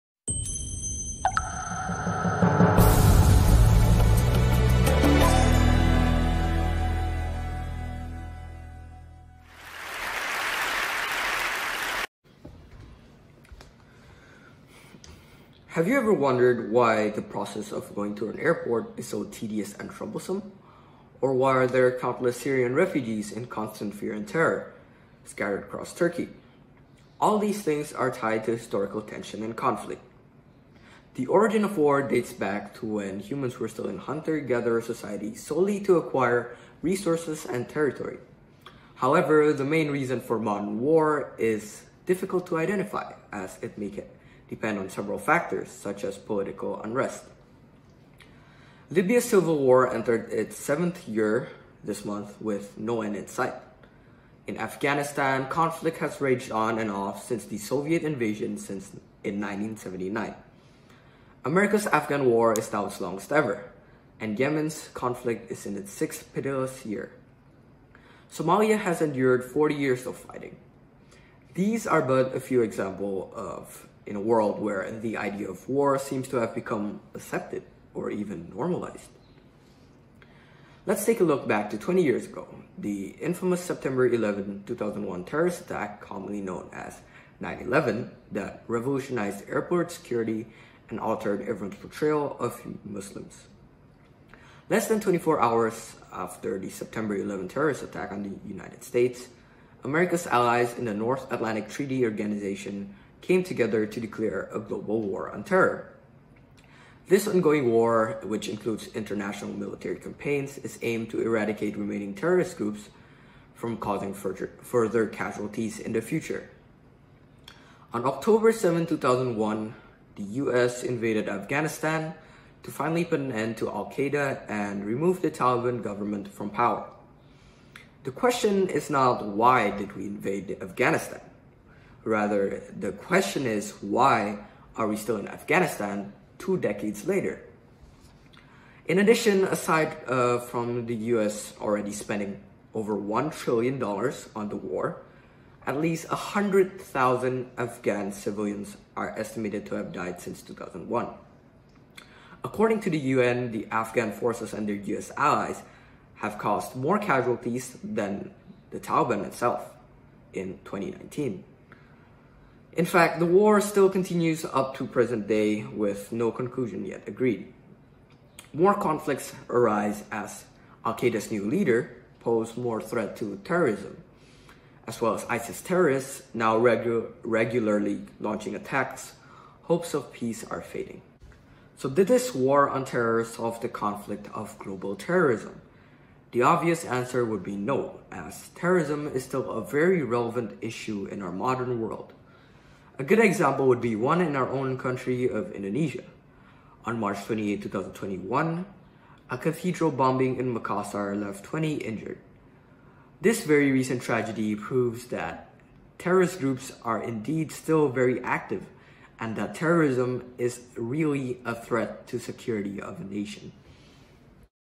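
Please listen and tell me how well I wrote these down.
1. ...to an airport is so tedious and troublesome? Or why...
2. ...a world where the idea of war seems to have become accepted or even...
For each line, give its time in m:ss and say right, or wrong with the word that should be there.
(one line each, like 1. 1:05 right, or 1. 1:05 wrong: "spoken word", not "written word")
1. 0:18 right
2. 1:14 right.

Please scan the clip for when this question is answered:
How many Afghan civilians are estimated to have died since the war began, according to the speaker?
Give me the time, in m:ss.
2:26.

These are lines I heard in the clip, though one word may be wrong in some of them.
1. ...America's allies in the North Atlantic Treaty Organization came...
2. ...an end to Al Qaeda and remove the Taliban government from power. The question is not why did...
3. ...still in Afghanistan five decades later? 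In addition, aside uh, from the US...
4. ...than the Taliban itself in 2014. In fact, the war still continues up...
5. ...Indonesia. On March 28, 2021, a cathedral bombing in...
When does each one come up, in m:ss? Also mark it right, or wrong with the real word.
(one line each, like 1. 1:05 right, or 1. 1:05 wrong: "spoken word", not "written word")
1. 1:39 right
2. 2:03 right
3. 2:14 wrong: "two", not "five"
4. 2:37 wrong: "2019", not "2014"
5. 3:15 right.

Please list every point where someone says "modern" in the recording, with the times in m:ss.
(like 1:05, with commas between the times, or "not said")
0:40, 3:11.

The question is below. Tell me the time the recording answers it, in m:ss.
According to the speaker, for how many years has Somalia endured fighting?
1:09.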